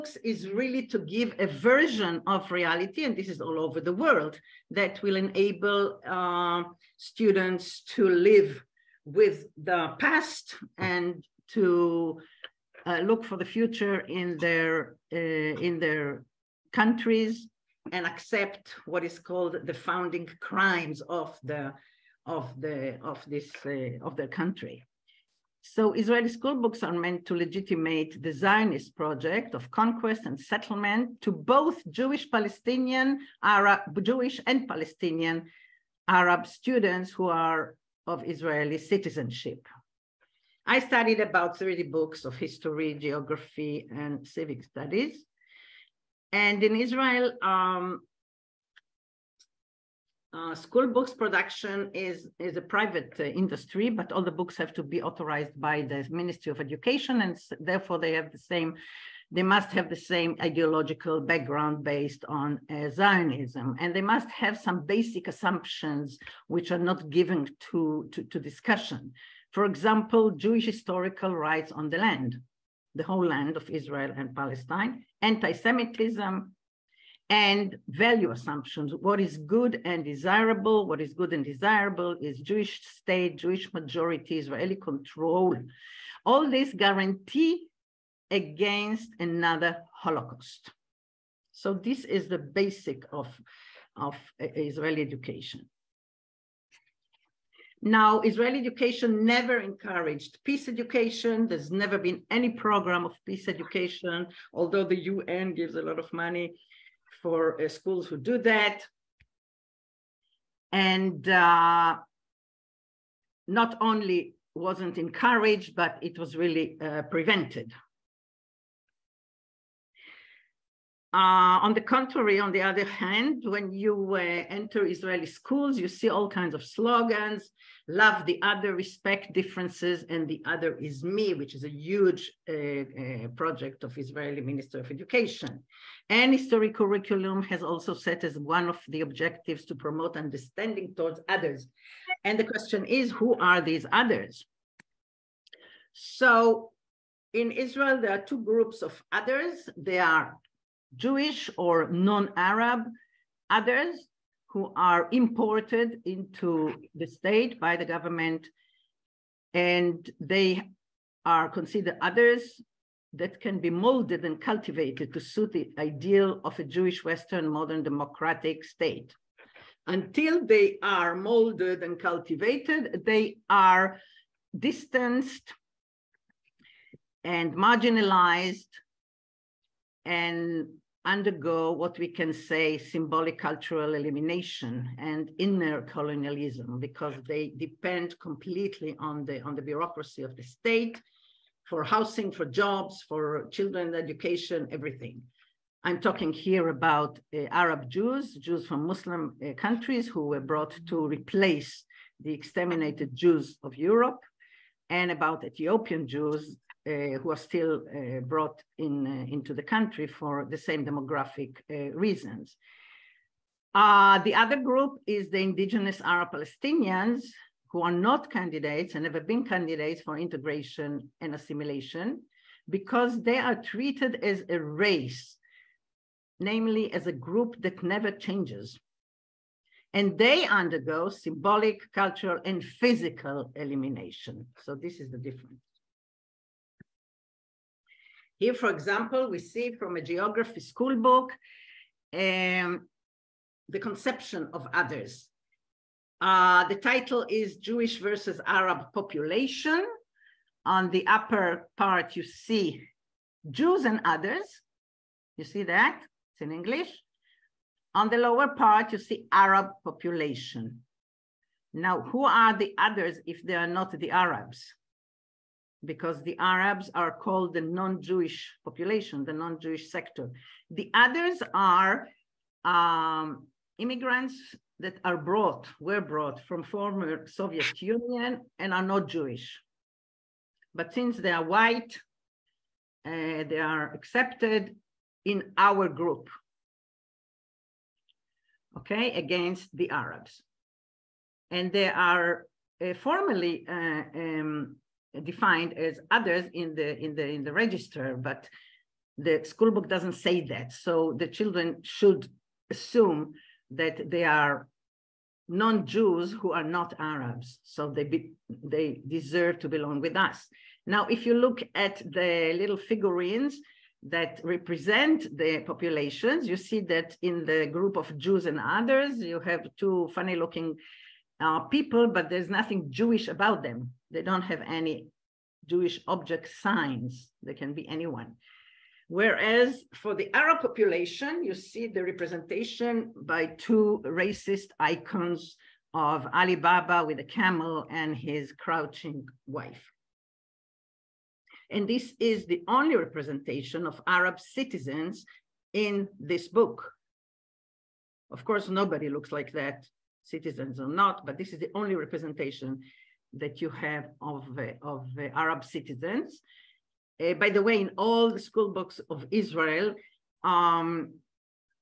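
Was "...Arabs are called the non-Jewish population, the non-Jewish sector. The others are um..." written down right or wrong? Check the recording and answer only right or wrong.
right.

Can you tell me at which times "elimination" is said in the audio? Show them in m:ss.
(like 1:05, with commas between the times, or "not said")
3:03, 3:53.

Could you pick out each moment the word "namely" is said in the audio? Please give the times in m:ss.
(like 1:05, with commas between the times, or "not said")
3:46.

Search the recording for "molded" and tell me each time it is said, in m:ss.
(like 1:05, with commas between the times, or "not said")
2:43, 2:51.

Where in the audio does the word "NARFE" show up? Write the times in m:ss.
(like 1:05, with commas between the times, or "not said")
not said.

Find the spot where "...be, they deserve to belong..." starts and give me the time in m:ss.
5:08.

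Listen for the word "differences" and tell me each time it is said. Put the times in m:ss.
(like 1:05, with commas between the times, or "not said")
2:09, 3:55.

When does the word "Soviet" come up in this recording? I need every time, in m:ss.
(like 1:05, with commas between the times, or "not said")
4:37.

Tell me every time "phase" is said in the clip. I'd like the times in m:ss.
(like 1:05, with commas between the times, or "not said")
not said.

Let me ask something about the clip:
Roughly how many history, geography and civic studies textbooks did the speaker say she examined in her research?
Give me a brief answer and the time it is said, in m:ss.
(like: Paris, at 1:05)
30, at 0:41.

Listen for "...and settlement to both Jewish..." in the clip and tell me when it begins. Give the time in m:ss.
0:30.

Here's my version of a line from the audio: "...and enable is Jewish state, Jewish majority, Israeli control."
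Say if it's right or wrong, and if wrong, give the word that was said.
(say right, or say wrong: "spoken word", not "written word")
wrong: "desirable", not "enable".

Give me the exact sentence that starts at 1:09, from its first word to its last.
For example, Jewish historical rights on the land, the whole land of Israel and Palestine, anti-Semitism, and value assumptions.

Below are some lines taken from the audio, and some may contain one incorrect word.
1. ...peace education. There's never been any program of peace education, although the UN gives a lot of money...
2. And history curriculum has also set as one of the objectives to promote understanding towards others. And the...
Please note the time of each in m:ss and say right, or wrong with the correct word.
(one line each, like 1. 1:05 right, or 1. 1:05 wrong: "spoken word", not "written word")
1. 1:40 right
2. 2:16 right.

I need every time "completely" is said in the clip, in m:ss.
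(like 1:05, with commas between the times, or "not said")
3:08.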